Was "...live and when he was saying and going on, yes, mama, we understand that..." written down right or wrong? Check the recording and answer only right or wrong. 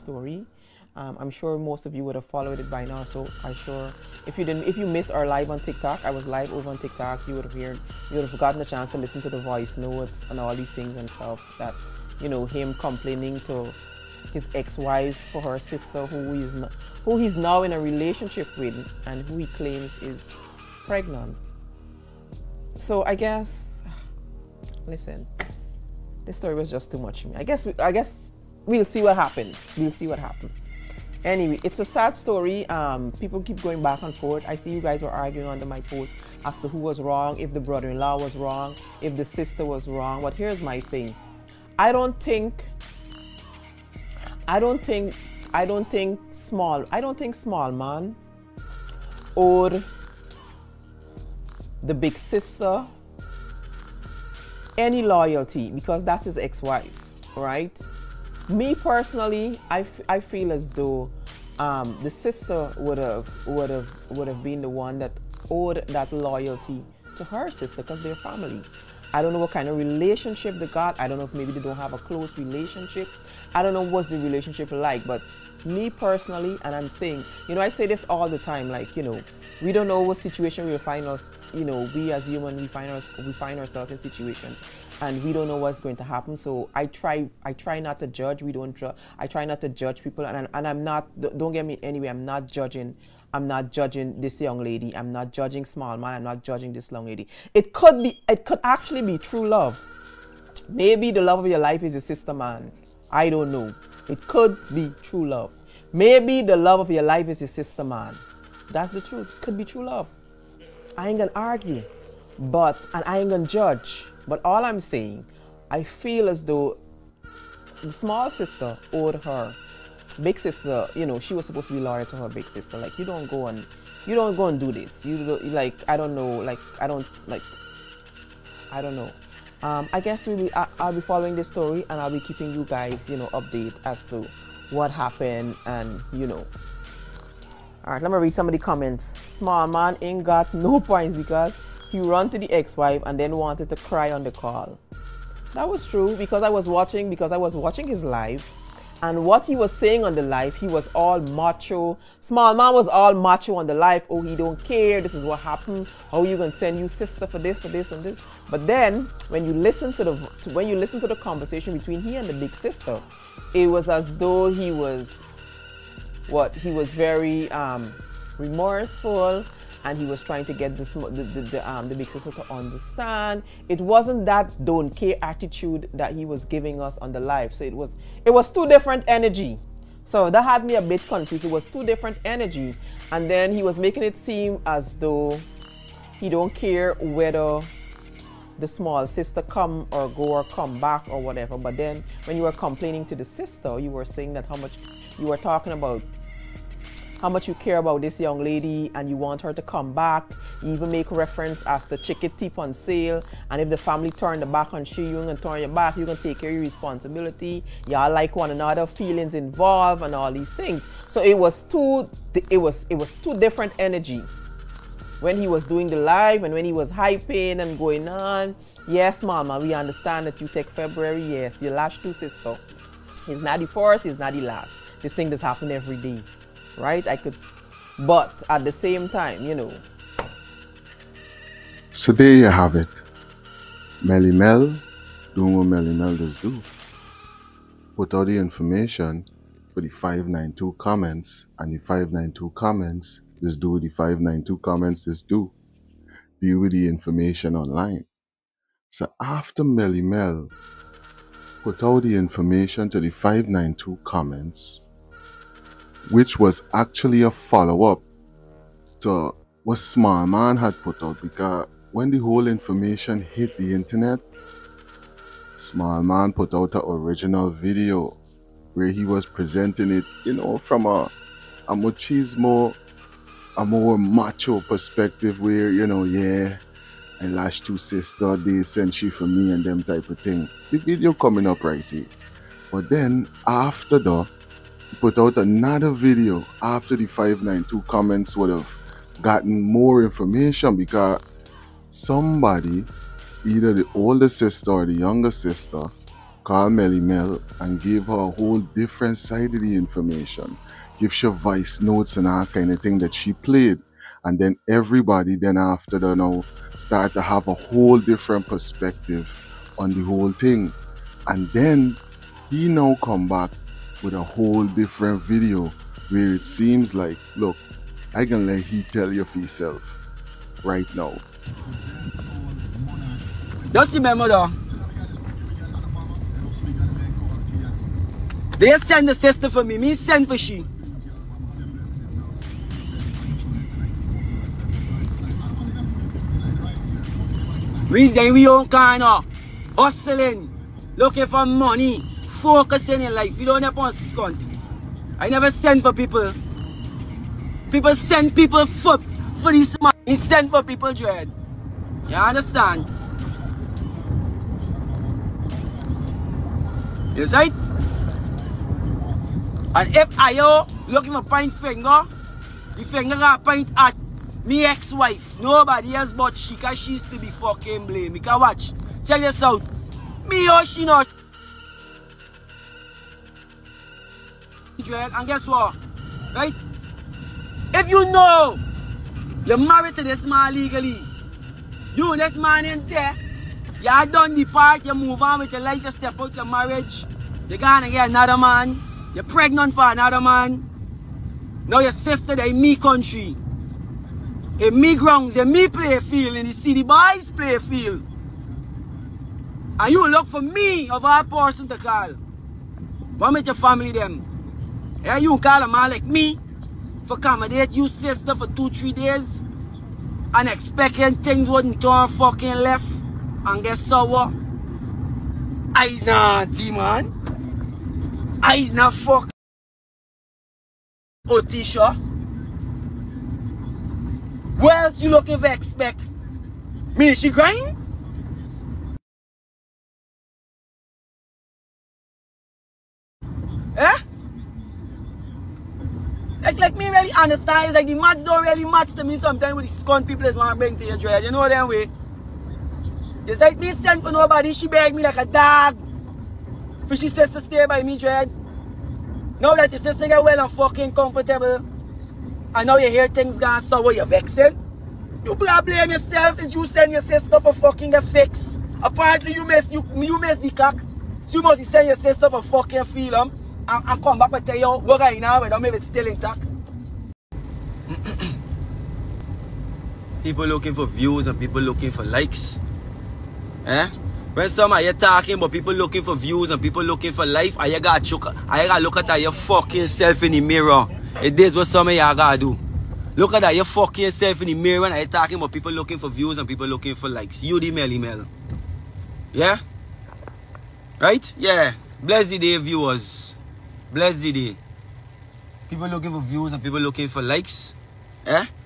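wrong.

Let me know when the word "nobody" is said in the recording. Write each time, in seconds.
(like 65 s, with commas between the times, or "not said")
365 s, 444 s.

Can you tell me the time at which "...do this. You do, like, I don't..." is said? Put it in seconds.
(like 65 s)
124 s.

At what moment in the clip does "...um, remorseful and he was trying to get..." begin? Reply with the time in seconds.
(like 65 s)
167 s.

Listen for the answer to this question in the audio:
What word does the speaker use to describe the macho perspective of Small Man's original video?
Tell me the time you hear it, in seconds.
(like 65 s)
271 s.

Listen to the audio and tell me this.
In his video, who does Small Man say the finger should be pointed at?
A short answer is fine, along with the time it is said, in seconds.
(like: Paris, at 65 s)
his ex-wife, at 364 s.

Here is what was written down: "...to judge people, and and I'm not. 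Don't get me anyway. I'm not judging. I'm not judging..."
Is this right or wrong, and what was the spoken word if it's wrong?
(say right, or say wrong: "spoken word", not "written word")
right.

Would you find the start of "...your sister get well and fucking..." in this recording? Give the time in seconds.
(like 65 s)
449 s.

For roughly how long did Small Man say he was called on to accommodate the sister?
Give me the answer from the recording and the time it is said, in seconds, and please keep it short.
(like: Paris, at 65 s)
two, three days, at 408 s.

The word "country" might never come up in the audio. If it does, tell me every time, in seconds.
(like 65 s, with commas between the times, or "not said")
392 s.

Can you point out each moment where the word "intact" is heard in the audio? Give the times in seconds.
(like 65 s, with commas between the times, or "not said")
466 s.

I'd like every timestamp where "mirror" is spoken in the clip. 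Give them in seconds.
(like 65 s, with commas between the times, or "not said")
480 s, 484 s.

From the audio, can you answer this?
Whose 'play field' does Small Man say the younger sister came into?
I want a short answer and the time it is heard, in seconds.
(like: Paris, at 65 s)
the city boys, at 396 s.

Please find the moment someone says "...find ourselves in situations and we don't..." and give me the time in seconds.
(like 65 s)
83 s.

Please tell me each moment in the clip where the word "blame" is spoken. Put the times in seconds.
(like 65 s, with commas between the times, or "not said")
367 s, 455 s.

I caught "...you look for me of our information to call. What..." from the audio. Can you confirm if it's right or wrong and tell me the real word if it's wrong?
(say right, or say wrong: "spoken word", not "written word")
wrong: "person", not "information".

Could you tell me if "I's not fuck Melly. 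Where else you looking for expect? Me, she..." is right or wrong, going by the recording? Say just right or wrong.
wrong.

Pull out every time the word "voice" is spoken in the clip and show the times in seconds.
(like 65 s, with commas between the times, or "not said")
9 s, 301 s.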